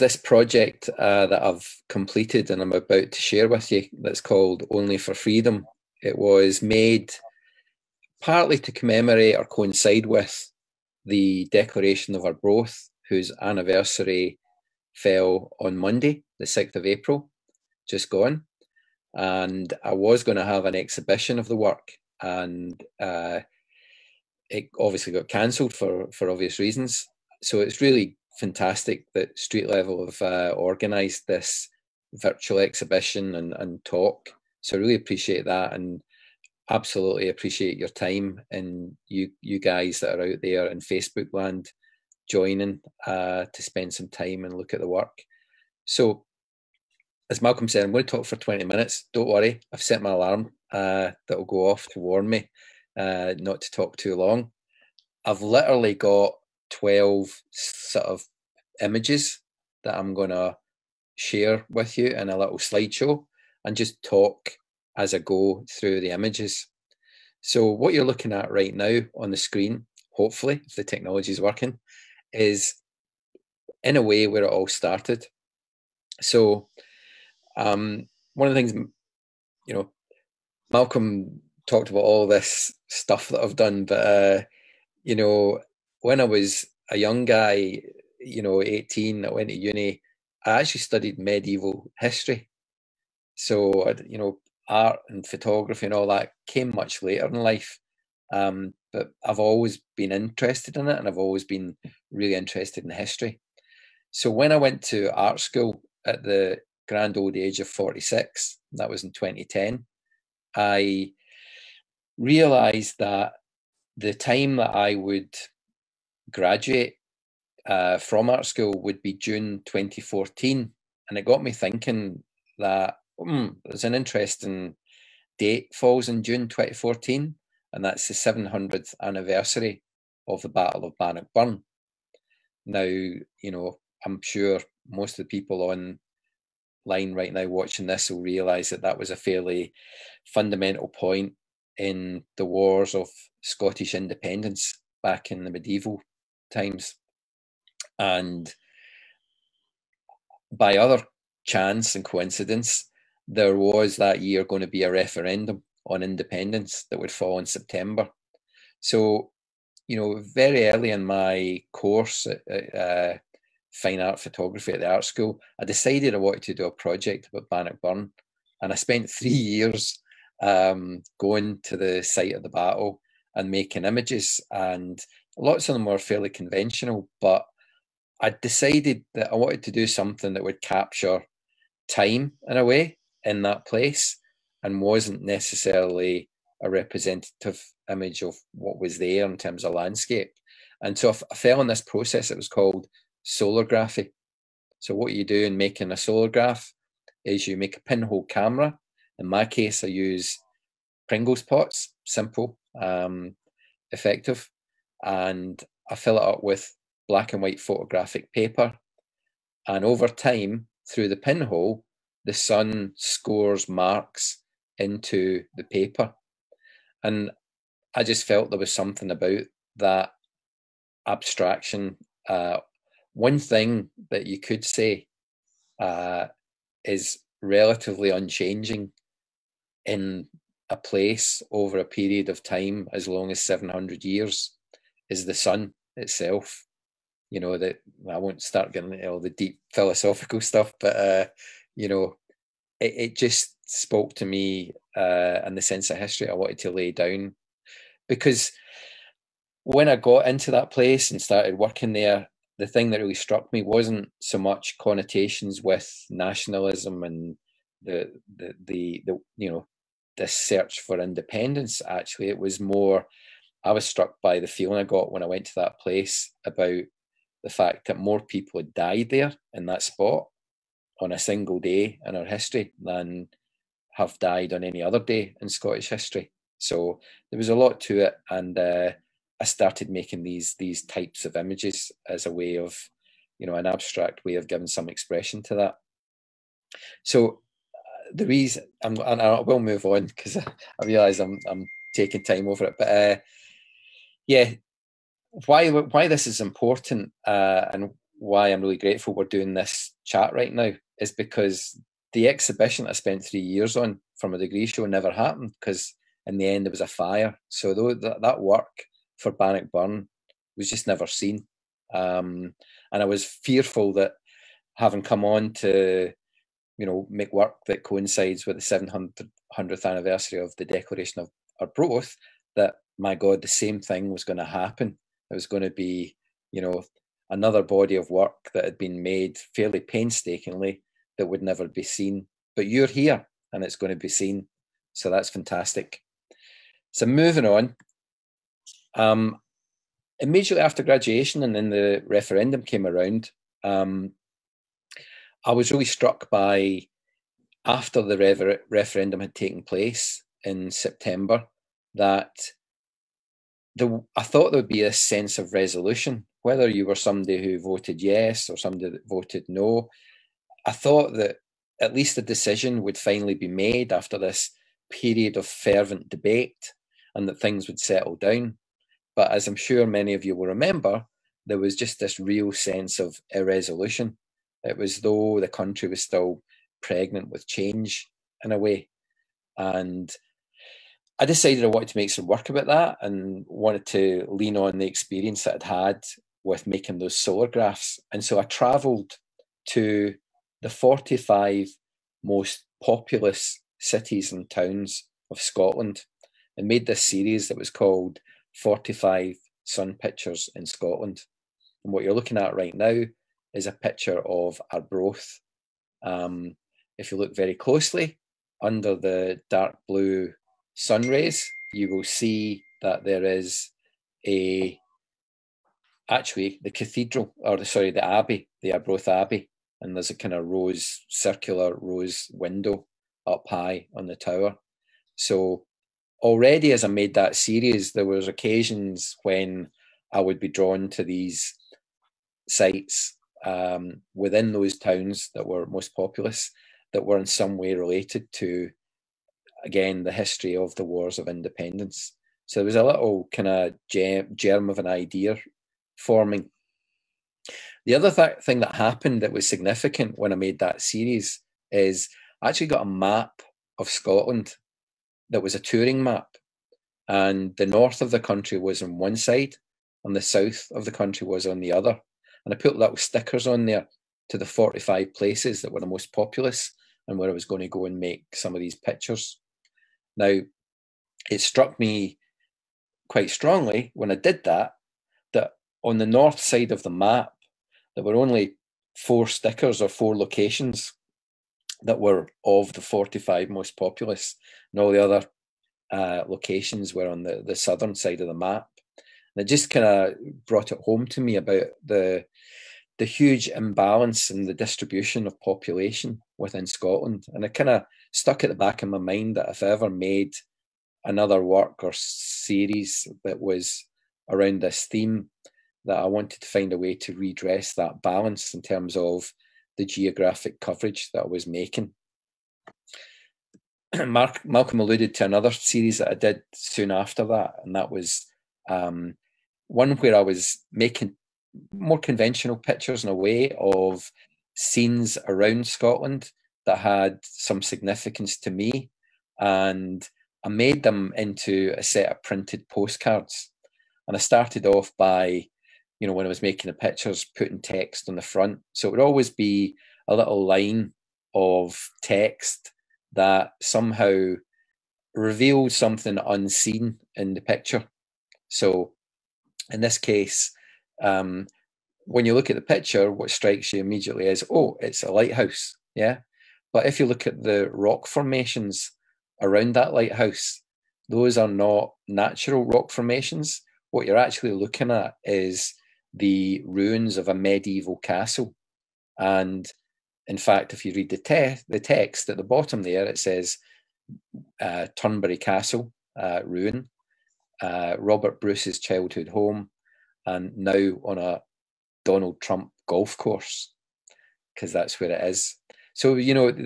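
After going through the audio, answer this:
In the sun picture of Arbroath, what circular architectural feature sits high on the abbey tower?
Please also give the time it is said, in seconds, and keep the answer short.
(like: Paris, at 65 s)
Rose window, at 421 s.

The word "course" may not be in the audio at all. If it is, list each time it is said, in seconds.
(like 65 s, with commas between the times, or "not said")
161 s, 583 s.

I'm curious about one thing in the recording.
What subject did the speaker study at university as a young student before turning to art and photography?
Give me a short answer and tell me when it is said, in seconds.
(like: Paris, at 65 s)
Medieval history, at 91 s.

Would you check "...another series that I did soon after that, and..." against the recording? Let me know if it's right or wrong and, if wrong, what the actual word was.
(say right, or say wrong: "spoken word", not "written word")
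right.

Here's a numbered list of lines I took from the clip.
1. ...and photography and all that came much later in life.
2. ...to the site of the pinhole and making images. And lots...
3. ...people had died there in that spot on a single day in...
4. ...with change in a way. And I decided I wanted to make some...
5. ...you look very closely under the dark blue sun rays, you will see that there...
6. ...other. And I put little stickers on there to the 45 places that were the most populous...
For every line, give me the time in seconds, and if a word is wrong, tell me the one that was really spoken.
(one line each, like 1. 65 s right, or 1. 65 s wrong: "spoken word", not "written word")
1. 95 s right
2. 171 s wrong: "battle", not "pinhole"
3. 268 s right
4. 377 s right
5. 407 s right
6. 461 s right.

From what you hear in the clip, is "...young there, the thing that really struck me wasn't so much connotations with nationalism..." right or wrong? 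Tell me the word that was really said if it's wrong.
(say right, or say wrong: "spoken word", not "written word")
wrong: "working", not "young".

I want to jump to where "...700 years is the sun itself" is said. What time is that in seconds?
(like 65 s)
233 s.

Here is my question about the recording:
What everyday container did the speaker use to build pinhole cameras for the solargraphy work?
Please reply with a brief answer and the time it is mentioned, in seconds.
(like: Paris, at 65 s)
Pringles pots, at 201 s.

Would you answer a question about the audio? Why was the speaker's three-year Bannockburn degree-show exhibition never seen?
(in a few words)
A fire.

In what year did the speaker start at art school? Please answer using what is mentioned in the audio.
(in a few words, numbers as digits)
2010.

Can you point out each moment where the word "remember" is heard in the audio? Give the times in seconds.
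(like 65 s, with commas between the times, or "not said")
370 s.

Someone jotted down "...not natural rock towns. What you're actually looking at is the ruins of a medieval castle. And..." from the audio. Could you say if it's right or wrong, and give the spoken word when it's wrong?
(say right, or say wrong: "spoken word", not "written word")
wrong: "formations", not "towns".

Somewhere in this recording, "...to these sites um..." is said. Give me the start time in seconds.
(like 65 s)
430 s.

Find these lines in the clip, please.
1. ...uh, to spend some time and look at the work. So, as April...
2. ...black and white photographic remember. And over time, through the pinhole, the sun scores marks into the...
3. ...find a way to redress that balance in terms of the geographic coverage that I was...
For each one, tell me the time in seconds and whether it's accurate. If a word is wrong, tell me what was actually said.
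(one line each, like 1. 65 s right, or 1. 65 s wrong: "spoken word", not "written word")
1. 43 s wrong: "Malcolm", not "April"
2. 207 s wrong: "paper", not "remember"
3. 506 s right.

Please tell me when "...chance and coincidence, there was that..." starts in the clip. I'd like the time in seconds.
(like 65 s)
151 s.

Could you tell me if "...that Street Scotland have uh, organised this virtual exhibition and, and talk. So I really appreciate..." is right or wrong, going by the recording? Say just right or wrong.
wrong.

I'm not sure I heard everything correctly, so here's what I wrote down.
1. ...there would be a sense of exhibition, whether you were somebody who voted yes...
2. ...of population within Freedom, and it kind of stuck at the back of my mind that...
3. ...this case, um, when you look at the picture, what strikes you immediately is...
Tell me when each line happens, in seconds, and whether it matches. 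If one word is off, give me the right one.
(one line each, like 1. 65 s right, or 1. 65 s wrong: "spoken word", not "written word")
1. 354 s wrong: "resolution", not "exhibition"
2. 495 s wrong: "Scotland", not "Freedom"
3. 549 s right.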